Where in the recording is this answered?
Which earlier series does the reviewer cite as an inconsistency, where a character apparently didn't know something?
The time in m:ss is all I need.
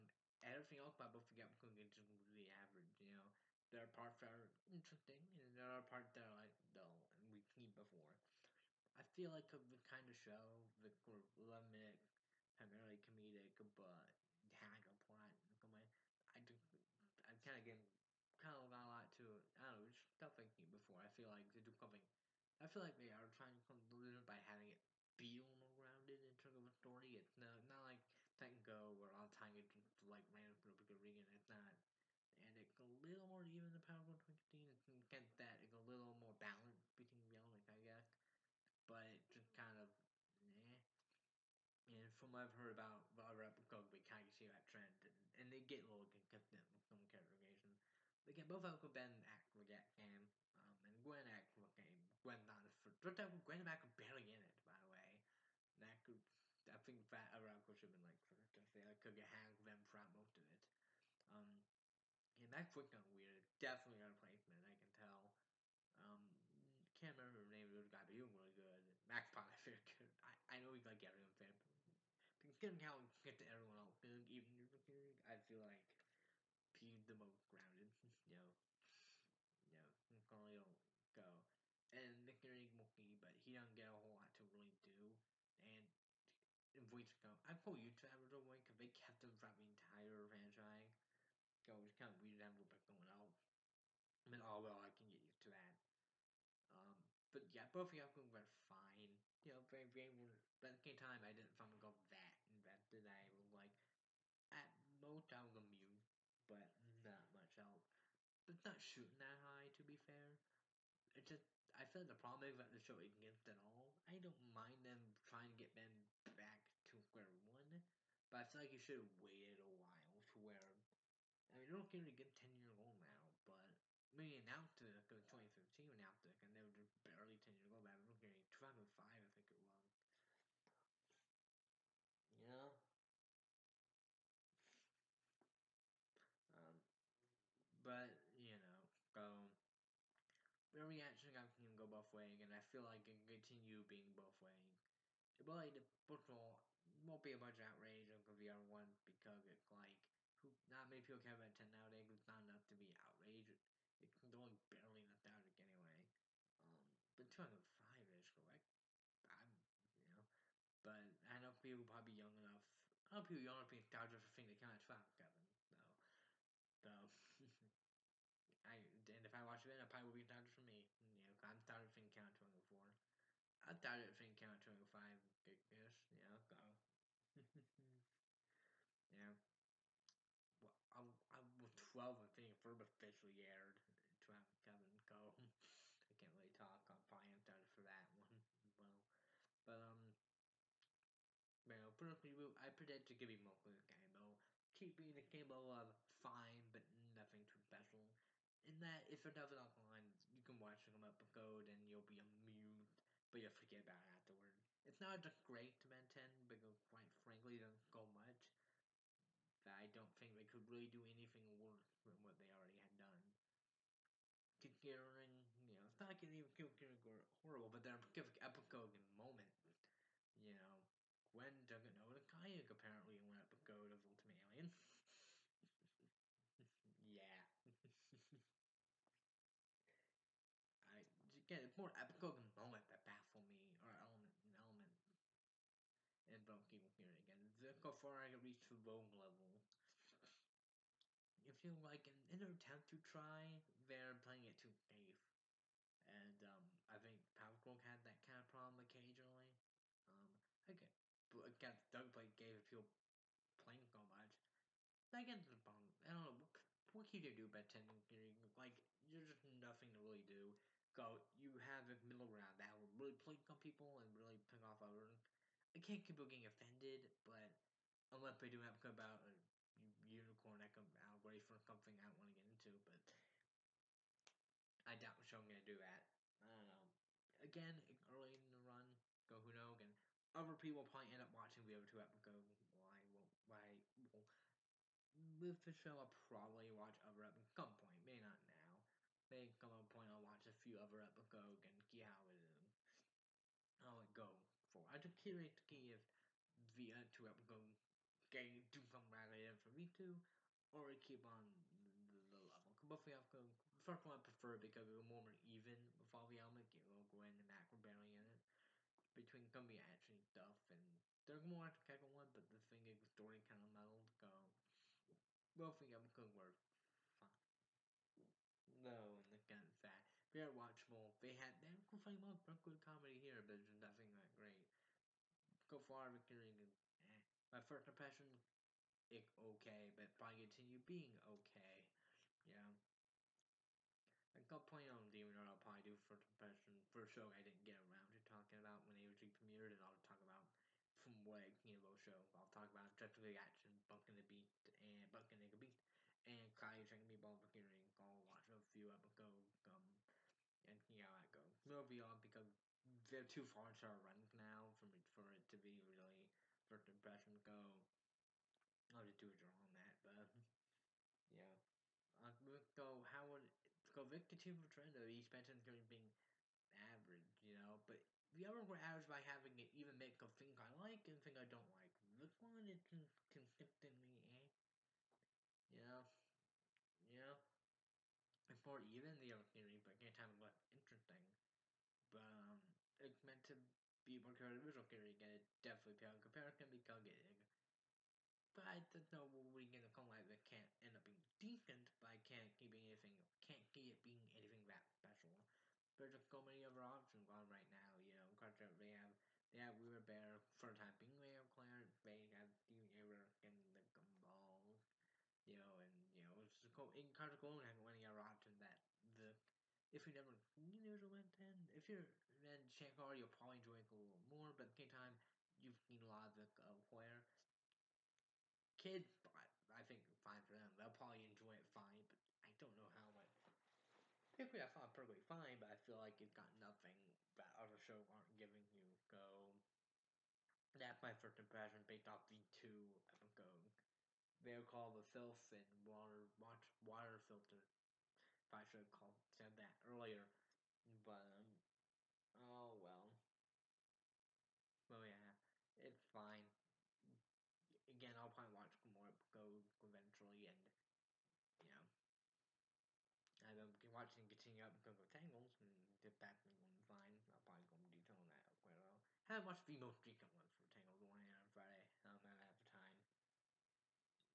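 3:44.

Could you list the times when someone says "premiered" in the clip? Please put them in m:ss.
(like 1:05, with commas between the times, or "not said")
5:39.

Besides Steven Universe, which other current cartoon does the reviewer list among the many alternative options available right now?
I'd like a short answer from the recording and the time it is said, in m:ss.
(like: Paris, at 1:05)
Gumball, at 6:43.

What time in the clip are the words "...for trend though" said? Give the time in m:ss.
6:04.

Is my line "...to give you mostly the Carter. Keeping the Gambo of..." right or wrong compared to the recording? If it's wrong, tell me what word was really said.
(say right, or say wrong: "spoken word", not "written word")
wrong: "Gambo", not "Carter".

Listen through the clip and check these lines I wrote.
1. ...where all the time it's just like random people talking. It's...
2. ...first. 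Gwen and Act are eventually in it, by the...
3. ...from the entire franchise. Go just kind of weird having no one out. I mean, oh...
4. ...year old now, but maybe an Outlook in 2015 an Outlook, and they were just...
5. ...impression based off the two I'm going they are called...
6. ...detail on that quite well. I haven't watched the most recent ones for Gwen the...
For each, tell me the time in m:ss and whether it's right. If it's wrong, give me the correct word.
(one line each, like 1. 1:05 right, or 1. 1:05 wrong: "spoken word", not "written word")
1. 0:28 wrong: "reading", not "talking"
2. 0:52 wrong: "barely", not "eventually"
3. 1:29 right
4. 2:02 right
5. 7:11 right
6. 7:37 wrong: "Tangles", not "Gwen".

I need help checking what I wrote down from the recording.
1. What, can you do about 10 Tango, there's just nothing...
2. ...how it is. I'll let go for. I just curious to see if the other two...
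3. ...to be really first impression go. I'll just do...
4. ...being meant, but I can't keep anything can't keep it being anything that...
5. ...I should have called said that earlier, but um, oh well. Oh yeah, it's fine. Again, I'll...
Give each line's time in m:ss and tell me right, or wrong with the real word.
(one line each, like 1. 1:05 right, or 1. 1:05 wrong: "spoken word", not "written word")
1. 4:16 wrong: "Like", not "Tango"
2. 4:52 right
3. 5:55 right
4. 6:31 wrong: "decent", not "meant"
5. 7:18 right.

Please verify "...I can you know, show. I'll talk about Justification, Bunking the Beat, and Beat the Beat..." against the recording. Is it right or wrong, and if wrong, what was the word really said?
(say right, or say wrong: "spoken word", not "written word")
wrong: "Bunking", not "Beat".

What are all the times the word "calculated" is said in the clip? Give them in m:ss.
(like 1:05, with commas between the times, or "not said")
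6:26.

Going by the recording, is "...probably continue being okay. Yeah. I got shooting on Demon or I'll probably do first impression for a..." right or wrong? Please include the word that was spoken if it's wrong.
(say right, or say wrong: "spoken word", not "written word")
wrong: "playing", not "shooting".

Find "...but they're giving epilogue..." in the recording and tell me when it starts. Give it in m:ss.
3:37.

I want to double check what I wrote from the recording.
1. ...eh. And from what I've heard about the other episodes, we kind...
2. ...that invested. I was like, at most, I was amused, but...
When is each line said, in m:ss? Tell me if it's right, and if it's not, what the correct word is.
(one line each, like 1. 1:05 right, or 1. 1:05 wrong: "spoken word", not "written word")
1. 0:40 right
2. 1:42 right.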